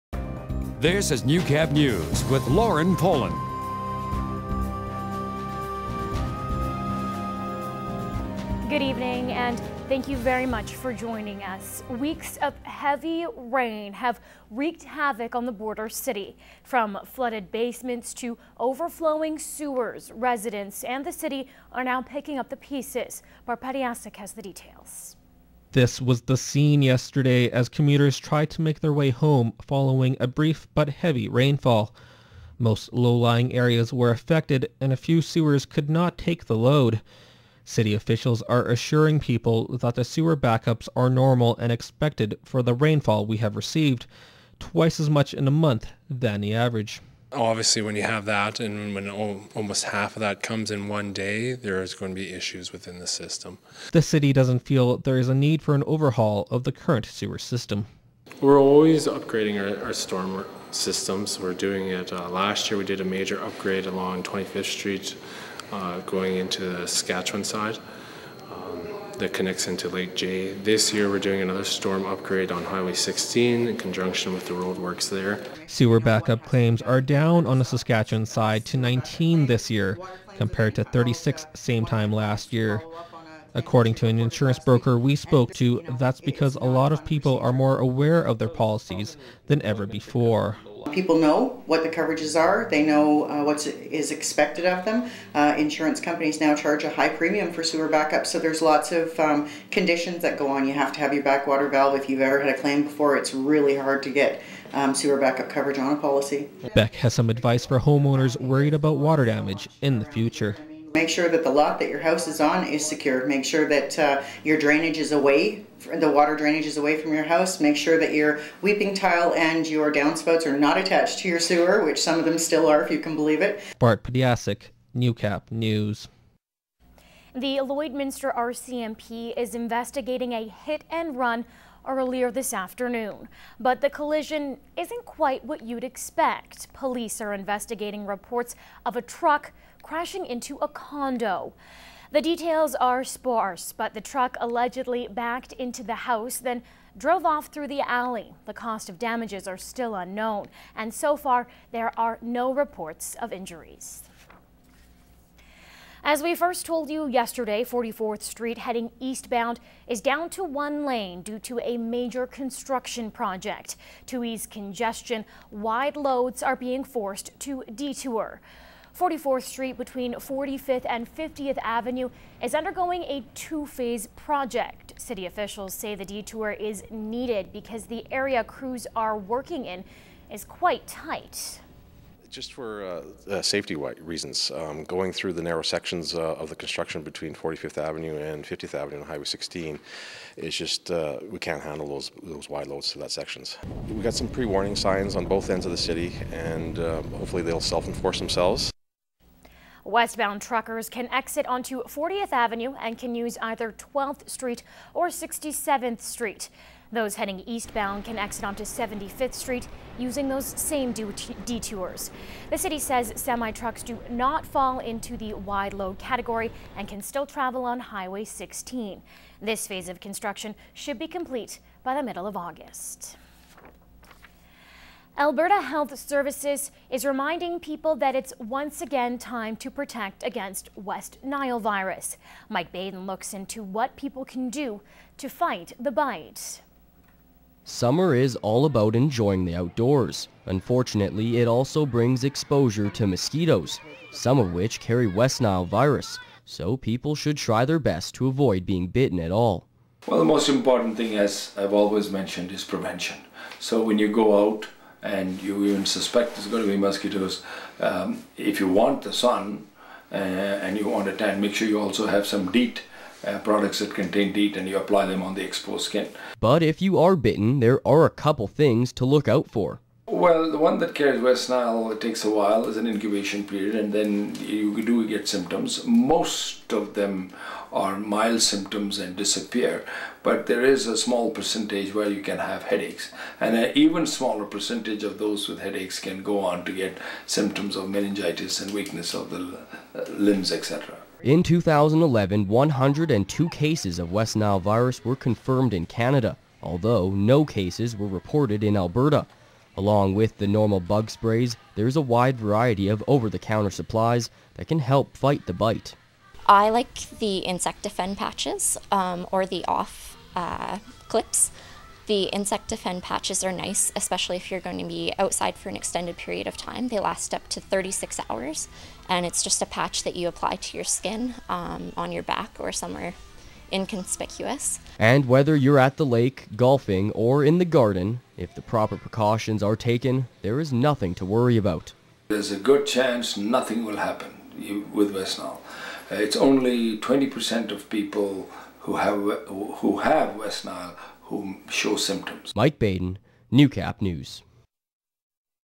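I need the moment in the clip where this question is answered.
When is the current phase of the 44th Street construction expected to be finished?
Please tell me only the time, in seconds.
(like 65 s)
222 s.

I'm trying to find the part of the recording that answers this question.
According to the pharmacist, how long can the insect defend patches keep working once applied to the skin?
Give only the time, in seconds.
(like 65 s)
317 s.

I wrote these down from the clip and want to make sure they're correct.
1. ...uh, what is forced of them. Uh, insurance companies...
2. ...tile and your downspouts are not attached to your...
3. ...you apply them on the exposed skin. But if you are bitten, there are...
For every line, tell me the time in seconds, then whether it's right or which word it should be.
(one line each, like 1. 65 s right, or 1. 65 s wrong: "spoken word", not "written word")
1. 93 s wrong: "expected", not "forced"
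2. 118 s right
3. 264 s right.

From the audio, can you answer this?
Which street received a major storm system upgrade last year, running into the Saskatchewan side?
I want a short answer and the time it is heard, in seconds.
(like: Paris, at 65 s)
25th Street, at 64 s.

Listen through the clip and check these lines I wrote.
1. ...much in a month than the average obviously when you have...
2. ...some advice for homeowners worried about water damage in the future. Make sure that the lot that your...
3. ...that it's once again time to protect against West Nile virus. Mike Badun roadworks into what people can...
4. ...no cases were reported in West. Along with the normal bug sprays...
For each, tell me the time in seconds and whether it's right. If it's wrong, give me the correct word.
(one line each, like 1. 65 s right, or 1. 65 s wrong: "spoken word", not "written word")
1. 45 s right
2. 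107 s right
3. 227 s wrong: "looks", not "roadworks"
4. 297 s wrong: "Alberta", not "West".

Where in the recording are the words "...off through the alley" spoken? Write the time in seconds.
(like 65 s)
147 s.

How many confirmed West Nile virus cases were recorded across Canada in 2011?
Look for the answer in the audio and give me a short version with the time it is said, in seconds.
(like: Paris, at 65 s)
102, at 292 s.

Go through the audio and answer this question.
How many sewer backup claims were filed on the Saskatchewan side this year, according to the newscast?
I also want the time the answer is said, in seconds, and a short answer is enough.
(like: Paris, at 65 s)
19, at 78 s.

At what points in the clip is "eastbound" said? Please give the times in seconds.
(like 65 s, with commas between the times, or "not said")
158 s, 207 s.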